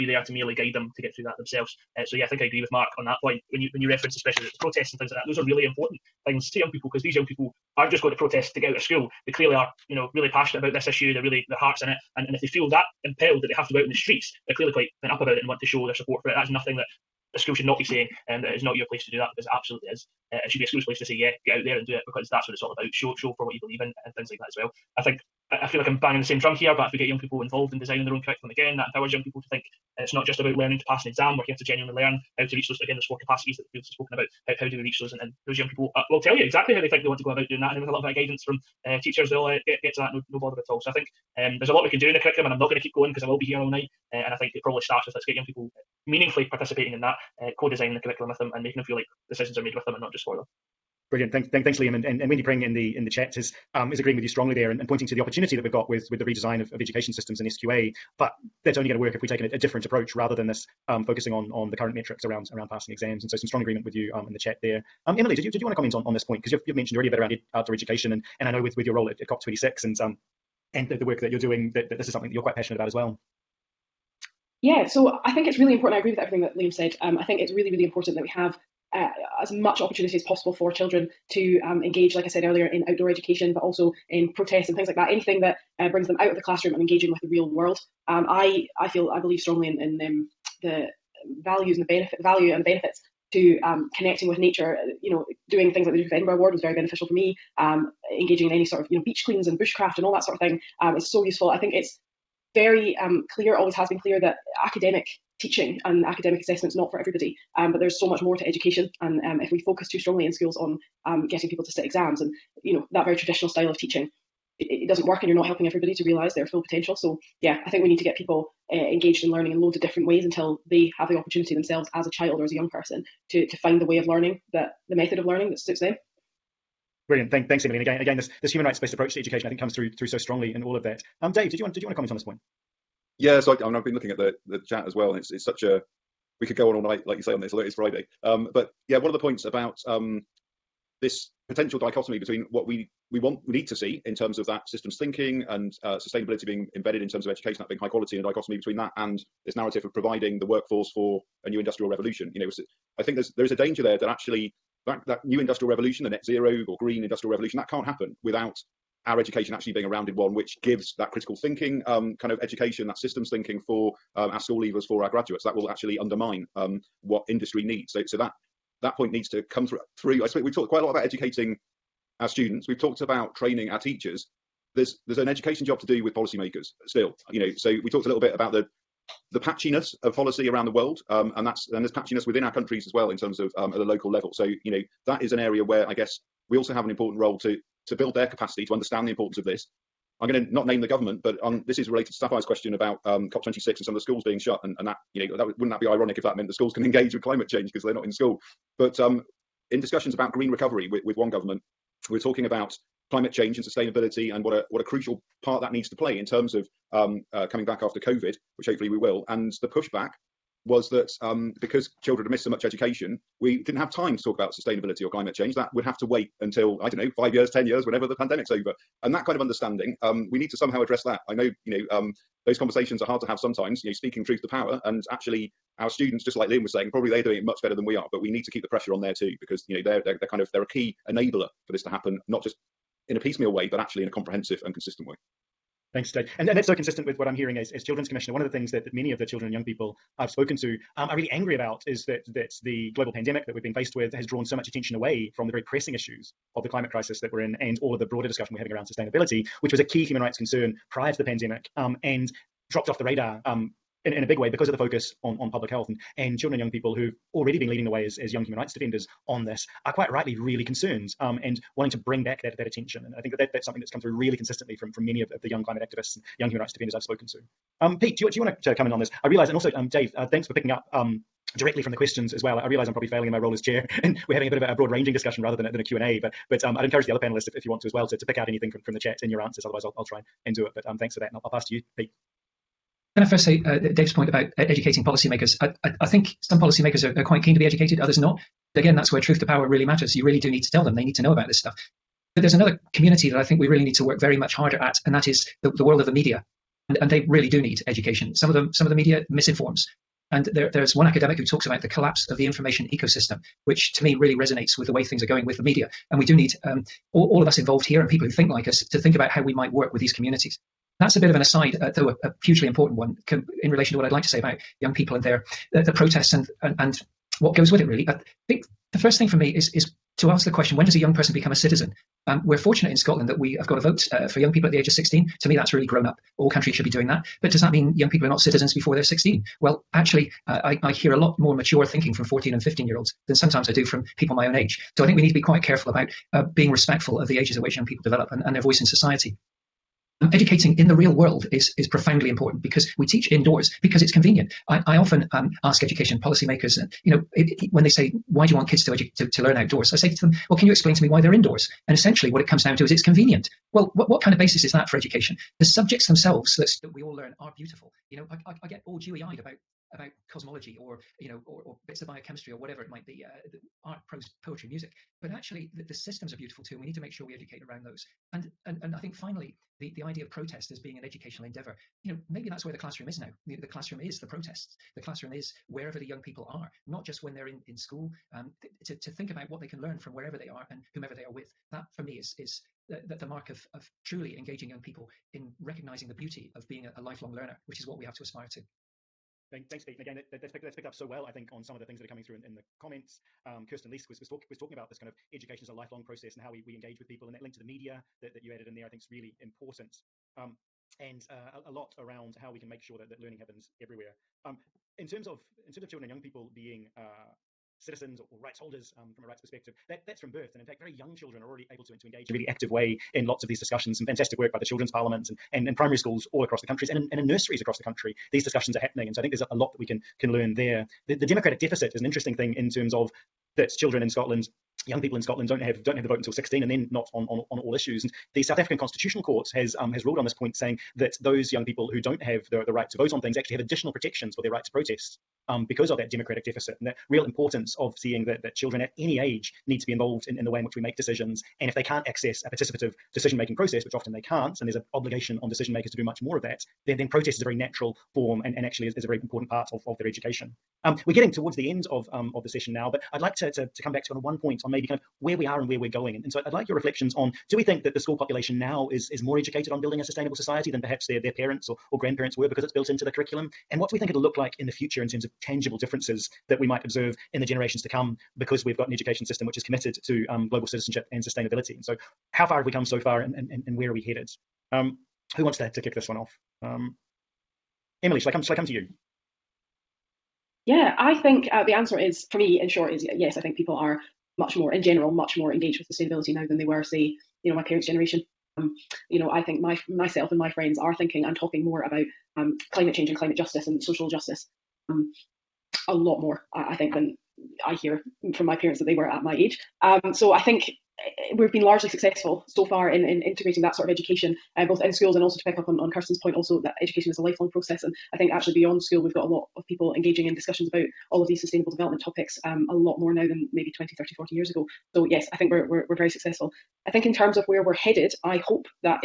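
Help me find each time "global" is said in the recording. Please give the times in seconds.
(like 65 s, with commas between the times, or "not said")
242 s, 470 s.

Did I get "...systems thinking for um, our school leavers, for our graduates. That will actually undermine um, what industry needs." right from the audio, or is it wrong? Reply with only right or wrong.
right.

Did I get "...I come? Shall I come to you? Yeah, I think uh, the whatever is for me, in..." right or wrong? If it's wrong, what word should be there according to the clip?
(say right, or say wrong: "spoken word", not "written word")
wrong: "answer", not "whatever".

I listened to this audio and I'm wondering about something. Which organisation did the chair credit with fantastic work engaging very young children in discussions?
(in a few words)
Children's Parliament.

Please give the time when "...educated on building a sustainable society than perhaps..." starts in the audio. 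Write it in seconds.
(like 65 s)
459 s.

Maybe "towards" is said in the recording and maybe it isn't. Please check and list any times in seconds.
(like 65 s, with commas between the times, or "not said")
451 s.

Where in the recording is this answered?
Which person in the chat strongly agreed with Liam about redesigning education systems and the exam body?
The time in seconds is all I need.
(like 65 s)
52 s.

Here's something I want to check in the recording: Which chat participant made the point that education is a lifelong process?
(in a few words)
Kirsten Leask.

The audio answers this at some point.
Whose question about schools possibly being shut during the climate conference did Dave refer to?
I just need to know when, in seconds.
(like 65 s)
192 s.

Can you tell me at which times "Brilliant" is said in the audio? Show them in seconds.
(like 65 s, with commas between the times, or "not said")
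51 s, 127 s.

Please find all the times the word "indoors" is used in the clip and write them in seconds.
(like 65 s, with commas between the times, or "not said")
343 s, 351 s.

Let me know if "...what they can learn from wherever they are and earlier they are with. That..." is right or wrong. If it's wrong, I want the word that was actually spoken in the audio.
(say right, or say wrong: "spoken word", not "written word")
wrong: "whomever", not "earlier".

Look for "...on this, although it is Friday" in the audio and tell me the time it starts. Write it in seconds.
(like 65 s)
137 s.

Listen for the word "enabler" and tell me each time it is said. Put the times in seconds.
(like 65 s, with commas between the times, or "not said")
231 s.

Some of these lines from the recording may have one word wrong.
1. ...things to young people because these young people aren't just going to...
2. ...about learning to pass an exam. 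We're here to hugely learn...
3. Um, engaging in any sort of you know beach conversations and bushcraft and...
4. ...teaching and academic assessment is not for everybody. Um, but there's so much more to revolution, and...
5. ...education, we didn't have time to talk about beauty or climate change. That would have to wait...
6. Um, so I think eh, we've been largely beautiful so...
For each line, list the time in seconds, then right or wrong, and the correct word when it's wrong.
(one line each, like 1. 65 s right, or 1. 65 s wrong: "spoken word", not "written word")
1. 6 s right
2. 30 s wrong: "genuinely", not "hugely"
3. 97 s wrong: "cleans", not "conversations"
4. 105 s wrong: "education", not "revolution"
5. 212 s wrong: "sustainability", not "beauty"
6. 499 s wrong: "successful", not "beautiful".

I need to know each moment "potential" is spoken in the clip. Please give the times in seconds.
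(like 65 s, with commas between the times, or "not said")
116 s, 141 s.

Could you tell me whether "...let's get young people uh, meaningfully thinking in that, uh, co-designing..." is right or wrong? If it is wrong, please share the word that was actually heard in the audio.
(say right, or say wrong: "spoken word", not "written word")
wrong: "participating", not "thinking".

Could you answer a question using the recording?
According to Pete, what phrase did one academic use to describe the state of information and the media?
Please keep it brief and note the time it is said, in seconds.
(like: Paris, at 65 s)
collapse of the information ecosystem, at 301 s.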